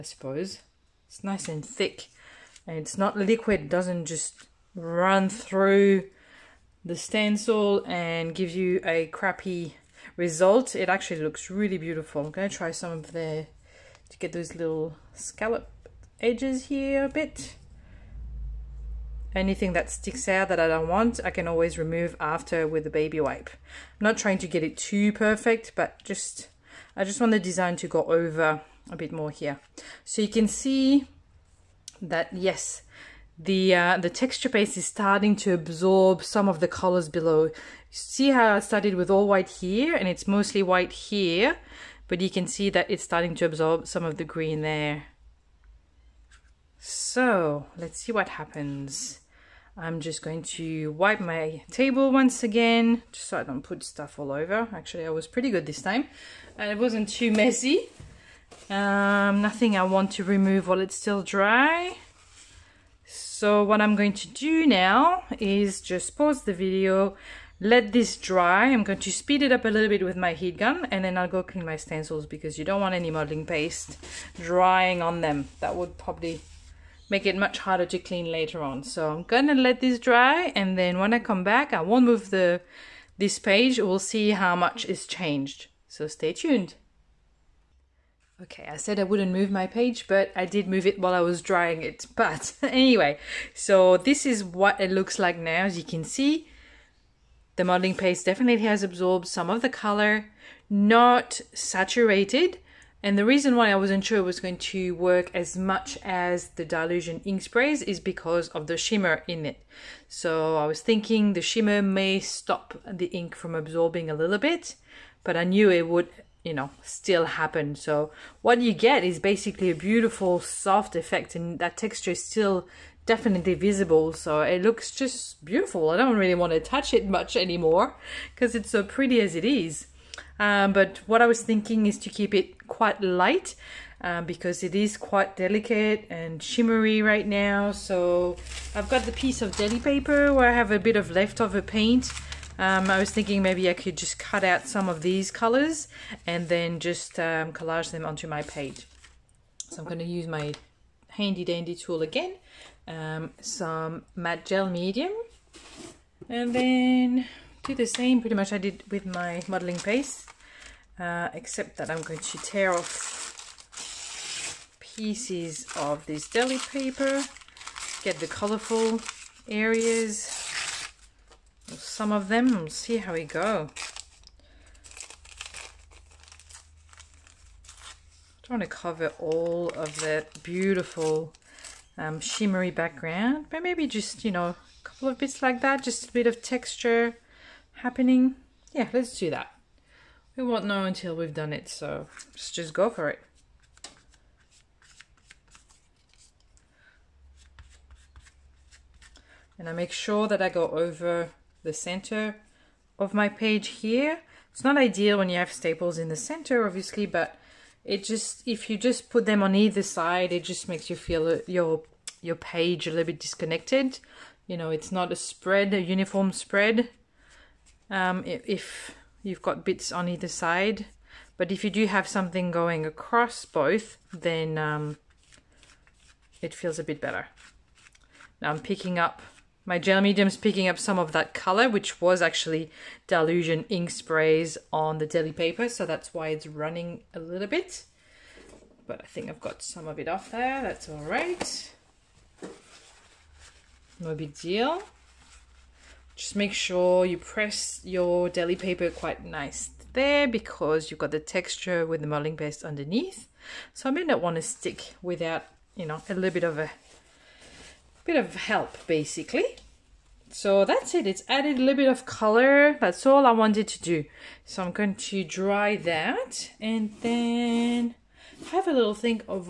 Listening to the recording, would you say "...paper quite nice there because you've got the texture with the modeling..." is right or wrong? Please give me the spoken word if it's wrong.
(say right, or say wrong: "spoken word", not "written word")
right.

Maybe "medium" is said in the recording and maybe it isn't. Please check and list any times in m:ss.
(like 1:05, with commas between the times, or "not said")
2:34, 3:50.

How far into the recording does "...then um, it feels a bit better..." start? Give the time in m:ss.
3:44.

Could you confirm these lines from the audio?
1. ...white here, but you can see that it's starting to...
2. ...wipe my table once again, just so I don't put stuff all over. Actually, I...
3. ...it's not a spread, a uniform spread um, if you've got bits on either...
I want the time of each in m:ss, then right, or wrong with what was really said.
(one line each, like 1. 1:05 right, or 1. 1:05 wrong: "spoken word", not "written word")
1. 0:40 right
2. 0:50 right
3. 3:34 right.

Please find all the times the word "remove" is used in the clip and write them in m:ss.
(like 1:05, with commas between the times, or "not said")
0:21, 1:00.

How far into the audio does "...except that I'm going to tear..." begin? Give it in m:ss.
2:41.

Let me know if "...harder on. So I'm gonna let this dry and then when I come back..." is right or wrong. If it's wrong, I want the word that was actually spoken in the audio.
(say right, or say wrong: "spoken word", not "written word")
wrong: "later", not "harder".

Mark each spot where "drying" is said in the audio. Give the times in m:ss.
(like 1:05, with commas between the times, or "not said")
1:14, 1:31.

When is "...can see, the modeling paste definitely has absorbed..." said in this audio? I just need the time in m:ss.
1:35.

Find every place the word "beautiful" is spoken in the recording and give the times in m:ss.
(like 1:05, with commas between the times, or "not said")
0:11, 1:59, 2:05, 3:00.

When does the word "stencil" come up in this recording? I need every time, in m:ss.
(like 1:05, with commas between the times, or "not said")
0:06, 1:11.